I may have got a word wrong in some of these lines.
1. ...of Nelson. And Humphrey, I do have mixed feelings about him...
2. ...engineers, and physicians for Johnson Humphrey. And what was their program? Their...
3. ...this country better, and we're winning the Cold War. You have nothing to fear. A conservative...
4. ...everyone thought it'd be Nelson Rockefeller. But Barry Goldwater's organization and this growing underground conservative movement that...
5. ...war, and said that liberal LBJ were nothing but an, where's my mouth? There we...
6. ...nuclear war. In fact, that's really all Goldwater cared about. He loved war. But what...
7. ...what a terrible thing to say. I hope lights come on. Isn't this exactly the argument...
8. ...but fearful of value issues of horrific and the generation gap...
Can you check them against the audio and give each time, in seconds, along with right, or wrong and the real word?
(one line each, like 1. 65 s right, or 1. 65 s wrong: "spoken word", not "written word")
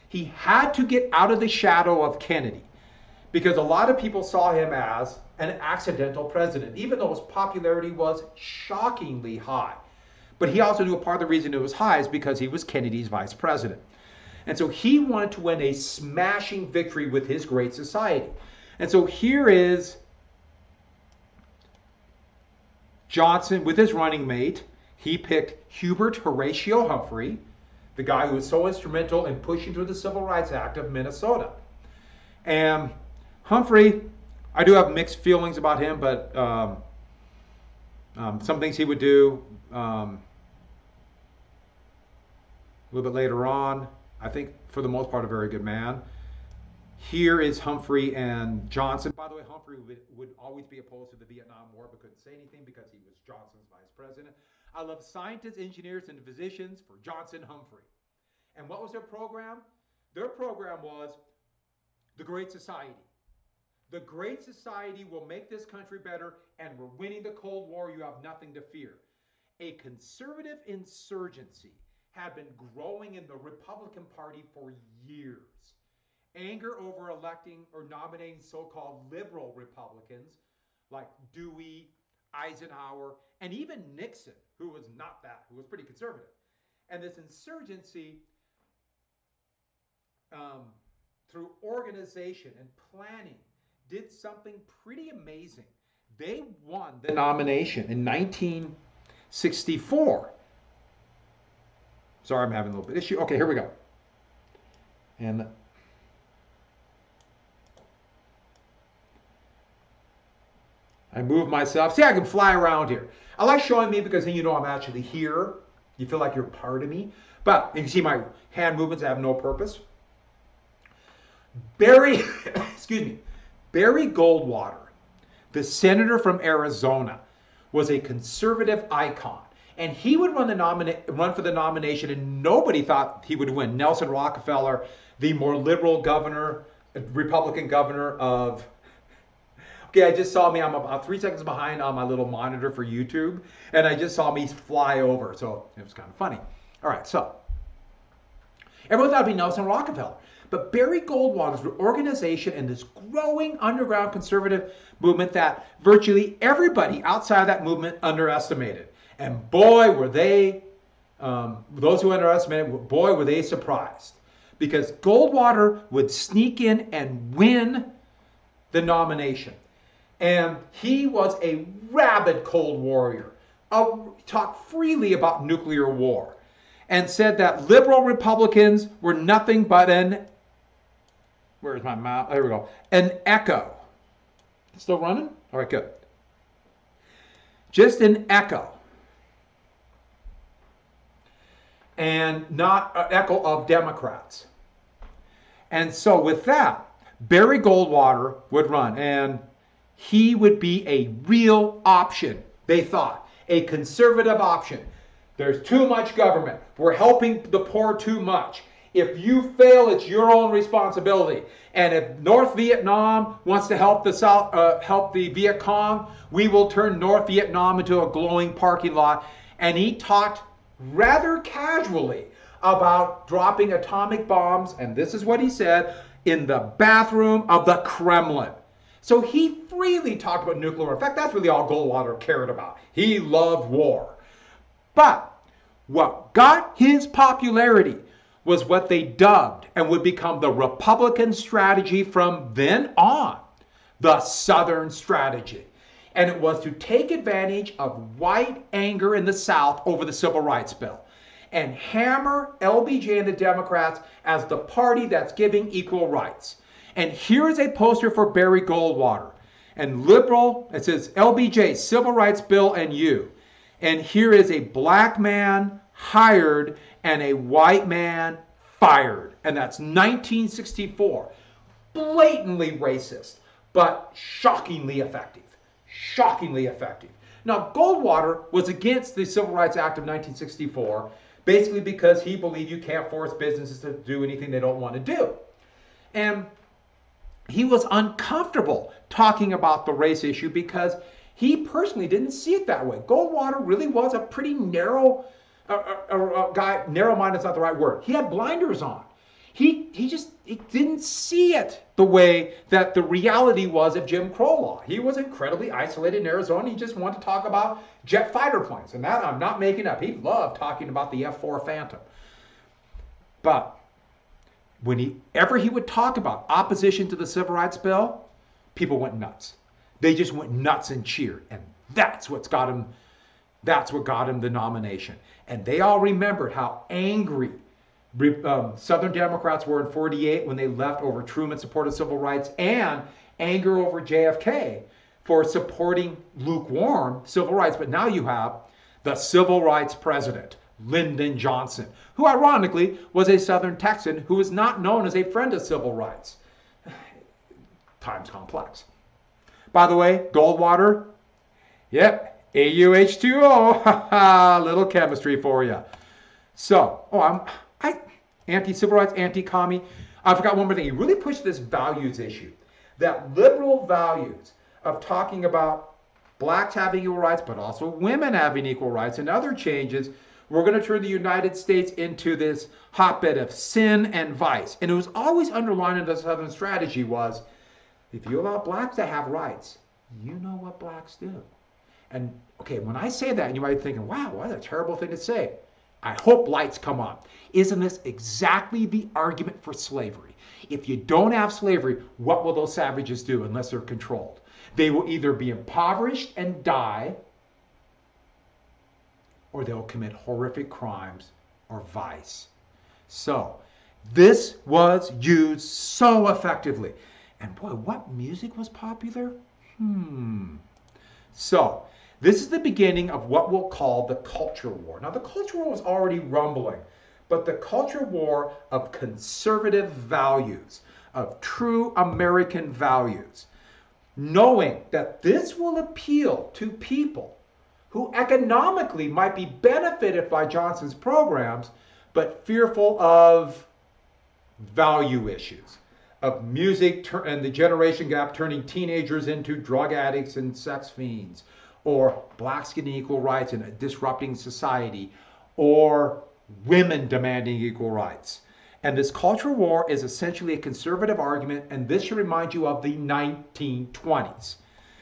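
1. 30 s wrong: "Minnesota", not "Nelson"
2. 55 s right
3. 65 s right
4. 148 s right
5. 175 s wrong: "Republicans", not "LBJ"
6. 230 s right
7. 384 s right
8. 432 s wrong: "music", not "horrific".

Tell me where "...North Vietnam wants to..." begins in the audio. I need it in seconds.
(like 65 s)
212 s.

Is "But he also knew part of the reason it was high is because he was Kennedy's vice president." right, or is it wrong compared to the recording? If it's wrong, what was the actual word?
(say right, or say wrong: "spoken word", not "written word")
right.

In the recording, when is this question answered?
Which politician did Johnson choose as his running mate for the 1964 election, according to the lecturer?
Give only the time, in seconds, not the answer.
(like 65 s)
25 s.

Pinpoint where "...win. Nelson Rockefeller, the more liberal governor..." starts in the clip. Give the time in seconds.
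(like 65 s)
133 s.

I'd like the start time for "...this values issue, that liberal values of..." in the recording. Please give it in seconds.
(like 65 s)
361 s.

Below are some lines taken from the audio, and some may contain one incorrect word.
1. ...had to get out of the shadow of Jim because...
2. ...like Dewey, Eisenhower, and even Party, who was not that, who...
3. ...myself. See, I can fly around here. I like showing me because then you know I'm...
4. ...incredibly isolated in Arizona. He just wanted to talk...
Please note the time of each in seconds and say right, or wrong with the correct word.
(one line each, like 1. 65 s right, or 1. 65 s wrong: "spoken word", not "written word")
1. 0 s wrong: "Kennedy", not "Jim"
2. 80 s wrong: "Nixon", not "Party"
3. 111 s right
4. 305 s right.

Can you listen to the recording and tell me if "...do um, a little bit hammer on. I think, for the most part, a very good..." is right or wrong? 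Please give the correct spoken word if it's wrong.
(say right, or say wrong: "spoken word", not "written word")
wrong: "later", not "hammer".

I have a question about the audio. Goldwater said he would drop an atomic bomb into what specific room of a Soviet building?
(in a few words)
the bathroom of the Kremlin.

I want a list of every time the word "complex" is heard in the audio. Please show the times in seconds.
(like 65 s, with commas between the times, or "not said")
348 s.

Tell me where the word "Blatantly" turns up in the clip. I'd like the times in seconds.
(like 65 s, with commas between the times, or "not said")
271 s.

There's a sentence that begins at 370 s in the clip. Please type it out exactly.
We're going to turn the United States into this hotbed of sin and vice.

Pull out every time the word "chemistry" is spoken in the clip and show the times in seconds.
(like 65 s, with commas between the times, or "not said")
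354 s.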